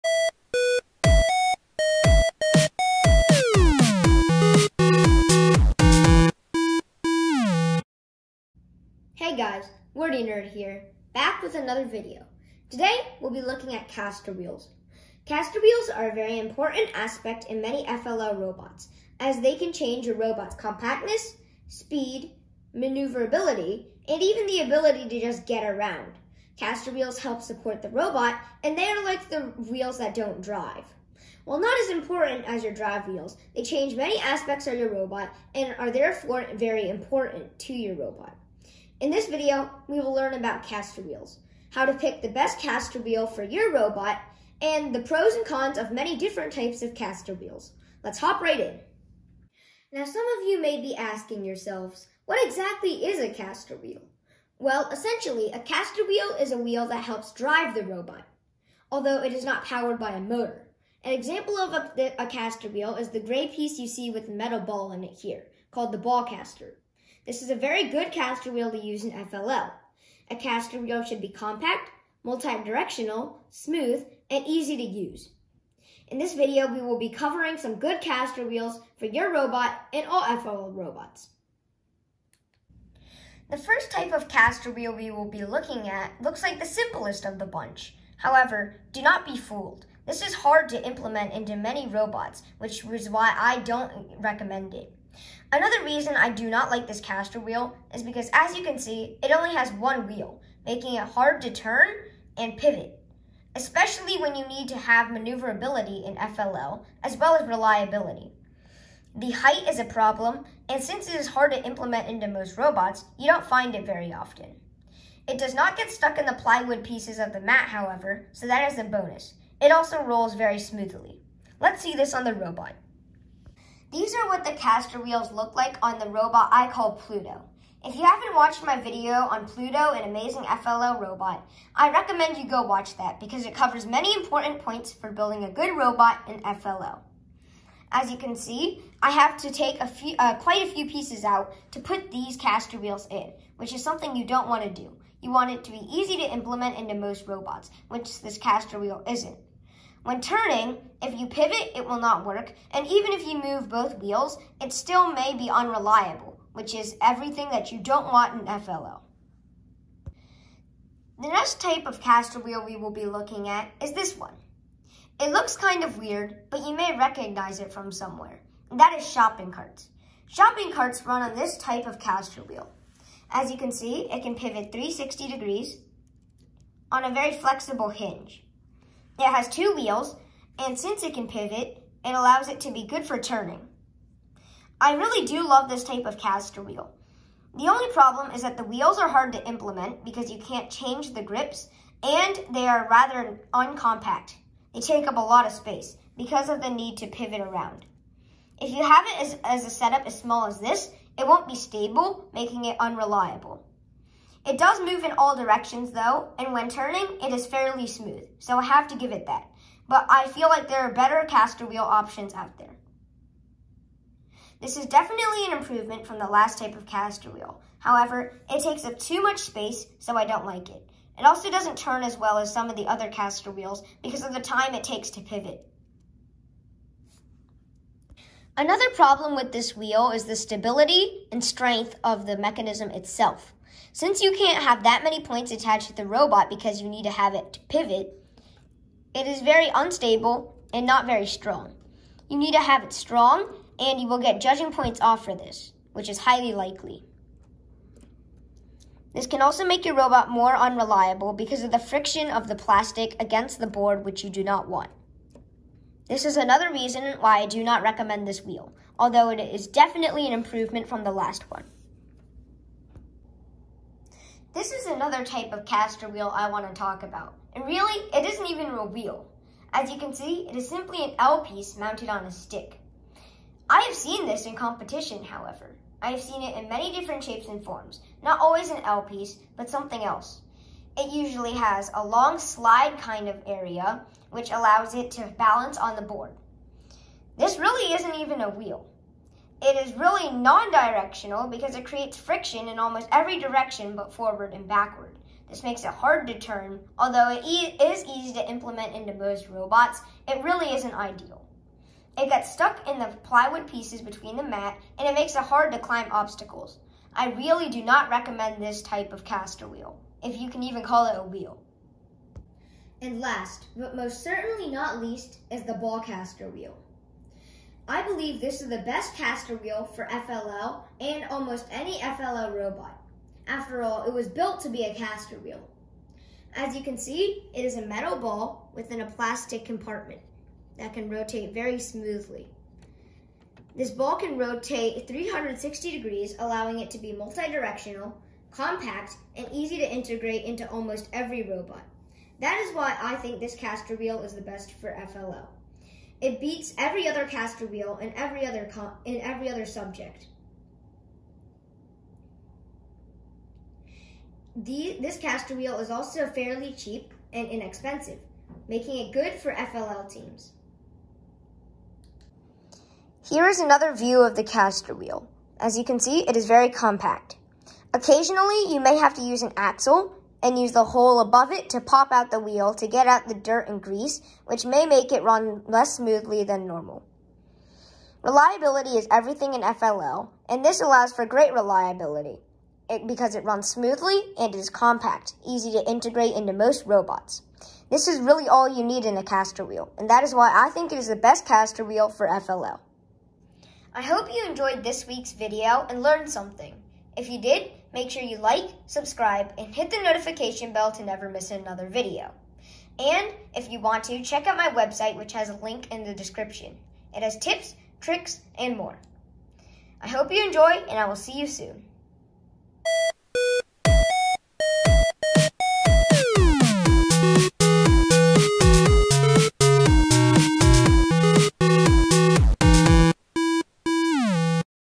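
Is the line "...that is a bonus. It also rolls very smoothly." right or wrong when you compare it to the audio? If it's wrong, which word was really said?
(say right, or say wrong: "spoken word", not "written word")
right.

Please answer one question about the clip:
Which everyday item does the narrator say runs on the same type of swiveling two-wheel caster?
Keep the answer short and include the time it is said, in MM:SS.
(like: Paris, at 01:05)
shopping carts, at 02:48.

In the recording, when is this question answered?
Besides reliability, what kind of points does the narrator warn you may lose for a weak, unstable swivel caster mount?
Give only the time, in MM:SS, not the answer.
04:04.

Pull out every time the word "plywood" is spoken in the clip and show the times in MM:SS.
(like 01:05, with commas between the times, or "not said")
01:56, 05:03.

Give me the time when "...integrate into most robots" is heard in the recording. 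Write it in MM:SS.
06:25.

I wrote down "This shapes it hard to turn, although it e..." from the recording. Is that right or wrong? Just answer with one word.
wrong.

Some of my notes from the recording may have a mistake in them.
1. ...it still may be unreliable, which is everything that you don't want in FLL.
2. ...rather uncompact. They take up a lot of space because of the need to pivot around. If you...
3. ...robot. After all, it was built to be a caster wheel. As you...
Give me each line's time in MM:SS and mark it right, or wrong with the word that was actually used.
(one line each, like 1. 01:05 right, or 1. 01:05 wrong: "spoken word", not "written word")
1. 02:34 right
2. 03:12 right
3. 05:22 right.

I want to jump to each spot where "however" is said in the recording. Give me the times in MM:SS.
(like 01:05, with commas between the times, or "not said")
01:28, 01:57, 03:37, 04:35.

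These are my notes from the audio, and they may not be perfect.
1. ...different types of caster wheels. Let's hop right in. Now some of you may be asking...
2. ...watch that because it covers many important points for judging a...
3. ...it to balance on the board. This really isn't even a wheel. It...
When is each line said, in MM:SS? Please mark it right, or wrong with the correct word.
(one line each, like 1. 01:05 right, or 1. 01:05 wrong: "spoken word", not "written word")
1. 00:46 right
2. 02:12 wrong: "building", not "judging"
3. 04:44 right.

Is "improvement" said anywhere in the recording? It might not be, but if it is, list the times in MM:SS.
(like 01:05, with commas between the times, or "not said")
03:35, 04:20.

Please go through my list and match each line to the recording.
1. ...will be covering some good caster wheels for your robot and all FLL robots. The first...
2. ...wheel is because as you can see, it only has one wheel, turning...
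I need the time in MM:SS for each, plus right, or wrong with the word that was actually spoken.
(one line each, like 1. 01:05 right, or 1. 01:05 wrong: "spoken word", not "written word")
1. 01:16 right
2. 01:37 wrong: "making", not "turning".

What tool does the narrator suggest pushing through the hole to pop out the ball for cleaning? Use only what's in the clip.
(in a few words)
an axle.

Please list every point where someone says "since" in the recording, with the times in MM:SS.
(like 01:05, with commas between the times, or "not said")
01:50, 03:00, 03:53.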